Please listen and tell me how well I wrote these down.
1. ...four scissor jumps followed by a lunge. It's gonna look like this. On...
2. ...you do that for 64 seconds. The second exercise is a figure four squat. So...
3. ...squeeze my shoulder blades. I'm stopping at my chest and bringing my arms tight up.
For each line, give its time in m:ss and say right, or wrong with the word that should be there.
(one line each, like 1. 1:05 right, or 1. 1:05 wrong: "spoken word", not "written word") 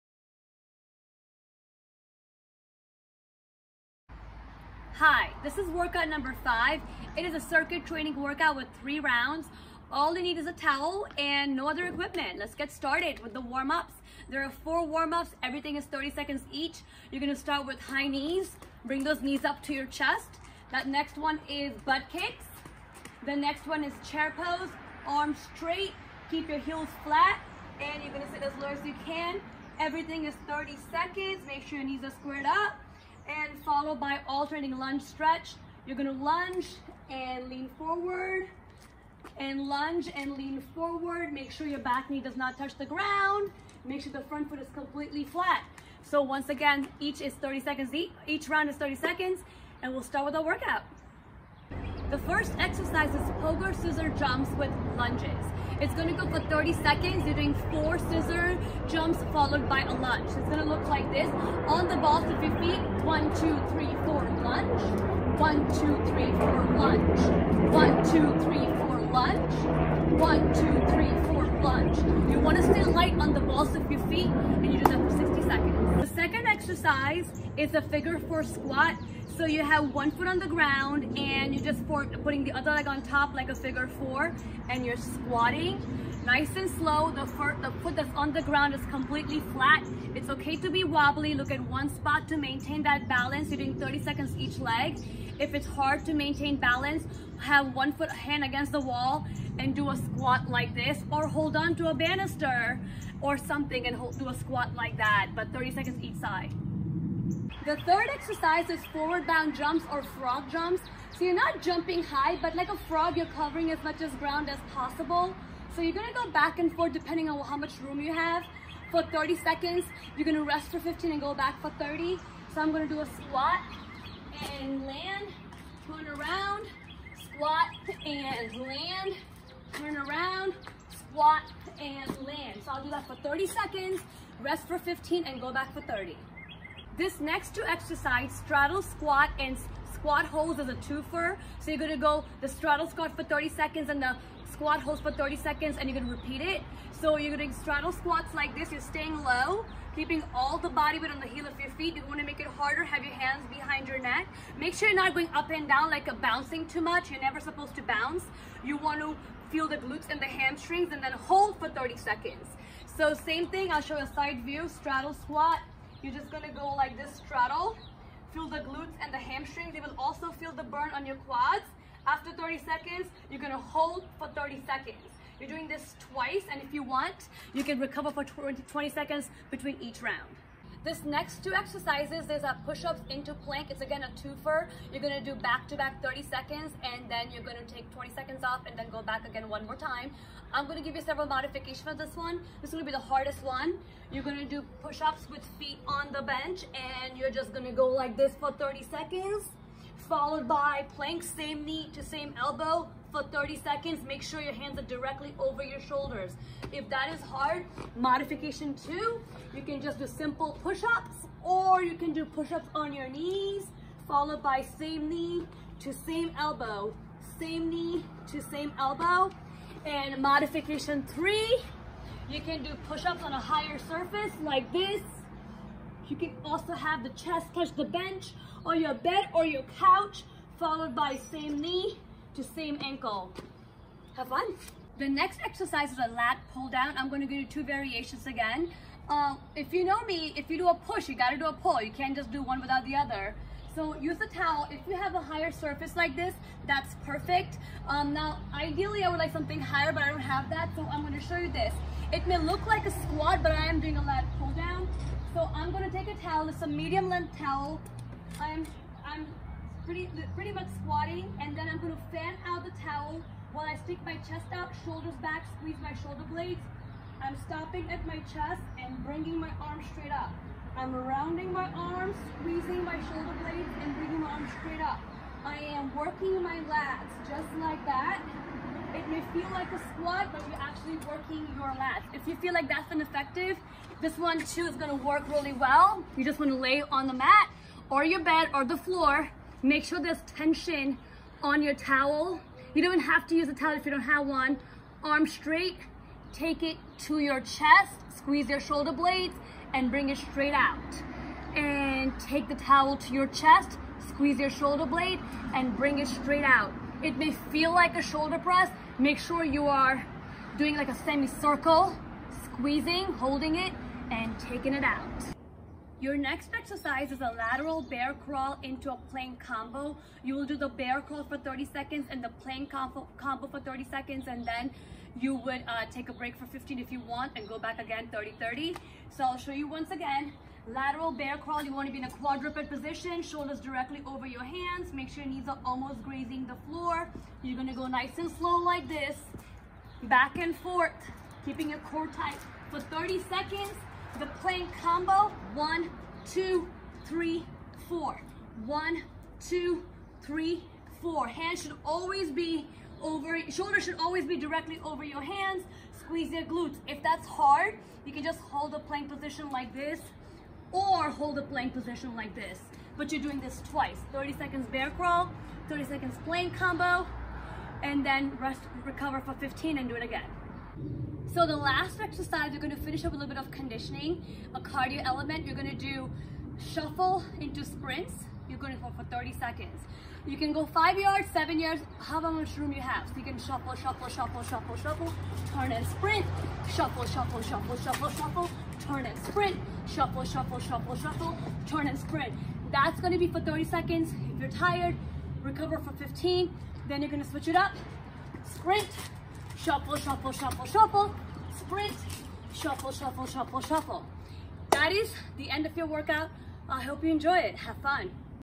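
1. 0:57 right
2. 1:14 wrong: "60", not "64"
3. 4:25 wrong: "straight", not "tight".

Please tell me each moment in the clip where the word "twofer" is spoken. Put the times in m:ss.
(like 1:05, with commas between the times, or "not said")
2:20, 3:04.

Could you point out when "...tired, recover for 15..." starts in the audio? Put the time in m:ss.
6:34.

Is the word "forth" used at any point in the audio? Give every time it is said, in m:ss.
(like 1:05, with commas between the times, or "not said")
1:56, 5:40.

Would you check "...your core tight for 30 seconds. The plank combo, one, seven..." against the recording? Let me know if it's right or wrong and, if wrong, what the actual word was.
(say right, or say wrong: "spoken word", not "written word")
wrong: "two", not "seven".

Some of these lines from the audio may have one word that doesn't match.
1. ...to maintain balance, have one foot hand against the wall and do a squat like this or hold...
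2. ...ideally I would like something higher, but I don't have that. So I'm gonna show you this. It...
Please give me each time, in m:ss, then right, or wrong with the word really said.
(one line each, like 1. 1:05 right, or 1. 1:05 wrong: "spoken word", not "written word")
1. 1:36 right
2. 4:08 right.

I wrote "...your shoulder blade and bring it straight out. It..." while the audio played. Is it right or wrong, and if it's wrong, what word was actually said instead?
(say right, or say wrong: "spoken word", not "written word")
right.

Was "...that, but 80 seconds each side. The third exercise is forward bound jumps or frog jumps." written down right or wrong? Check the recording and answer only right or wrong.
wrong.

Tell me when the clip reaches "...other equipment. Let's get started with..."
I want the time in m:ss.
0:11.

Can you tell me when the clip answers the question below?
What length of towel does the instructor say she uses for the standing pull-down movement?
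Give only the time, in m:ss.
4:16.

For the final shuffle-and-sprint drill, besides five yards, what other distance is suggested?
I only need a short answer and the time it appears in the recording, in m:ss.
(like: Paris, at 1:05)
7 yards, at 6:21.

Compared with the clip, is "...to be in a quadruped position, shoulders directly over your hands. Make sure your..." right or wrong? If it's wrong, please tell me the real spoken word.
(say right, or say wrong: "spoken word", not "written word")
right.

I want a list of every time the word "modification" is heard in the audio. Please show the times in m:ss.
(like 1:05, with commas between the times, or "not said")
3:11, 3:27, 3:40.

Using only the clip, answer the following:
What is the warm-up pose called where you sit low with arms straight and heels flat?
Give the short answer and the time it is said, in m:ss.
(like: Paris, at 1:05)
chair pose, at 0:24.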